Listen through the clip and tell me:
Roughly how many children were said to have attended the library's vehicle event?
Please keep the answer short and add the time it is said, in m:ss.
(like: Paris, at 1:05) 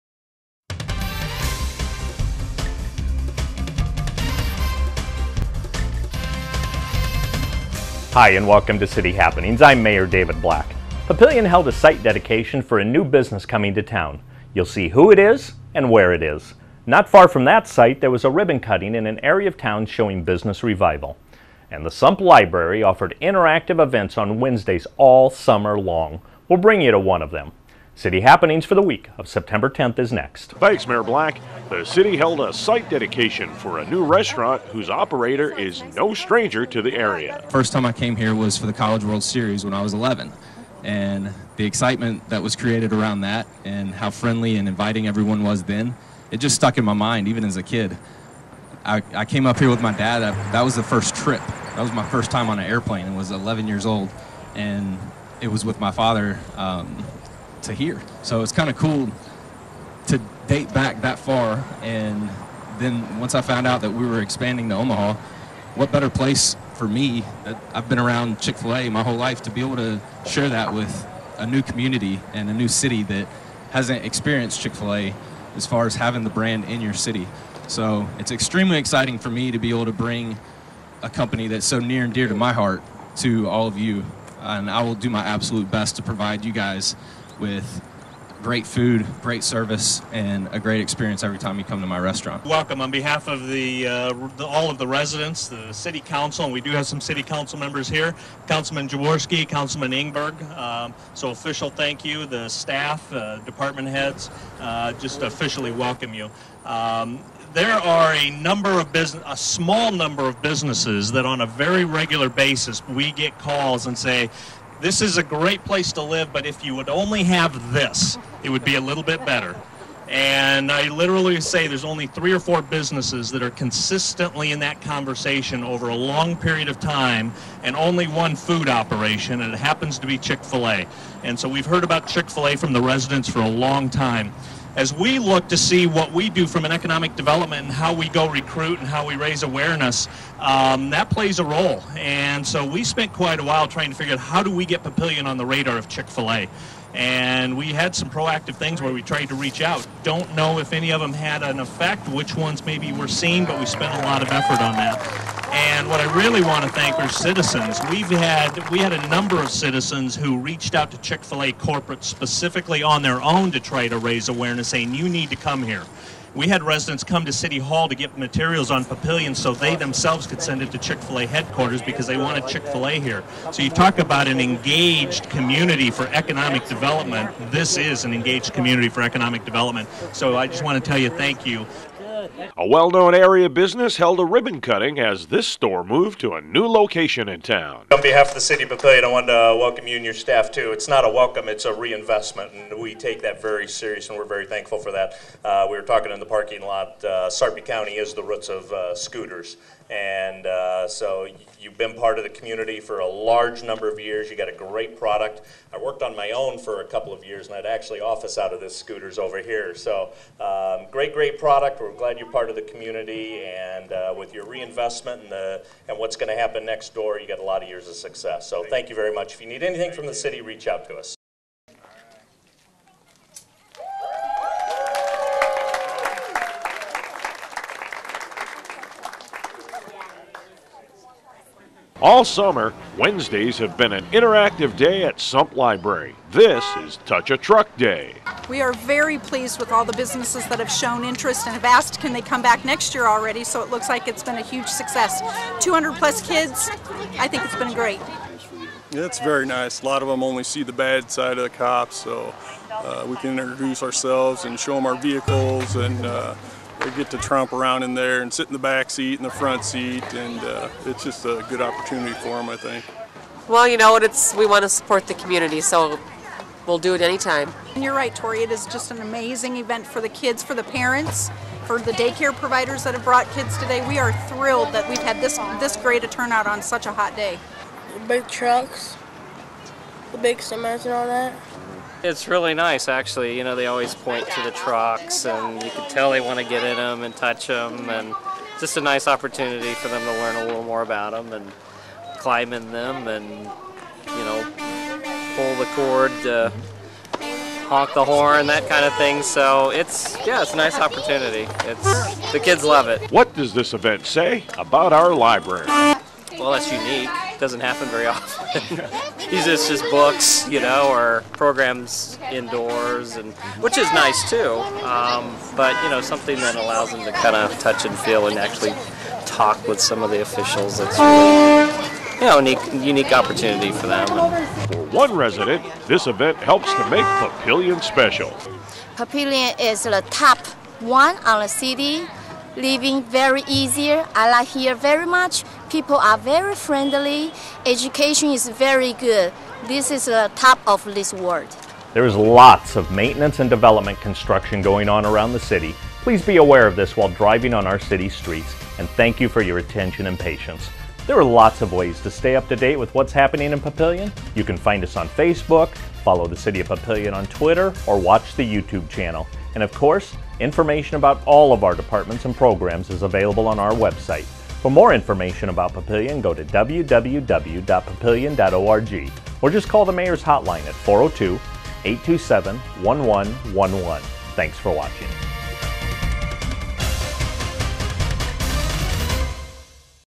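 200 plus, at 4:05.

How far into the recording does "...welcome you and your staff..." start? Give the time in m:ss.
3:09.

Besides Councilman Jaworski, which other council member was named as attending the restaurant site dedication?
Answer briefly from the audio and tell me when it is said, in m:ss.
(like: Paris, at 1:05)
Councilman Ingberg, at 1:39.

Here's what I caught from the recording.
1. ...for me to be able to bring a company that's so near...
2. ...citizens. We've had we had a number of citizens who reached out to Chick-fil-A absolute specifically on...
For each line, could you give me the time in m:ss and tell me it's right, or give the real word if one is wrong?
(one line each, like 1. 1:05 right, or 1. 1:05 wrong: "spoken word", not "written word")
1. 1:19 right
2. 2:37 wrong: "corporate", not "absolute".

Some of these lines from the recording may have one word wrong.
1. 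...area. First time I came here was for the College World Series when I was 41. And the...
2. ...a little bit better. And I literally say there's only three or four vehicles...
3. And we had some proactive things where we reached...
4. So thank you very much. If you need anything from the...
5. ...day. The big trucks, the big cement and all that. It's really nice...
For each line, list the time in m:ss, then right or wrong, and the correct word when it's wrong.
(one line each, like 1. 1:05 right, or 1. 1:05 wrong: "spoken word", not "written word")
1. 0:36 wrong: "11", not "41"
2. 1:58 wrong: "businesses", not "vehicles"
3. 2:26 wrong: "tried", not "reached"
4. 3:38 right
5. 4:37 right.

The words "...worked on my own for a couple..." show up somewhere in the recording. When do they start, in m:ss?
3:25.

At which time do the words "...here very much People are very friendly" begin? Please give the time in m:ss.
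5:34.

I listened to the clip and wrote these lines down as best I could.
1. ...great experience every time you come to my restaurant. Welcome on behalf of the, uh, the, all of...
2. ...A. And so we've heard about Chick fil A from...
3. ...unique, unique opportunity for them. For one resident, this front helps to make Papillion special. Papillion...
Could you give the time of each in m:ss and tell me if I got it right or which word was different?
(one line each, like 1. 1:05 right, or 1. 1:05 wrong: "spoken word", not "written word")
1. 1:30 right
2. 2:10 right
3. 5:22 wrong: "event", not "front".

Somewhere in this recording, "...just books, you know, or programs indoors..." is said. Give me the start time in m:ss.
5:09.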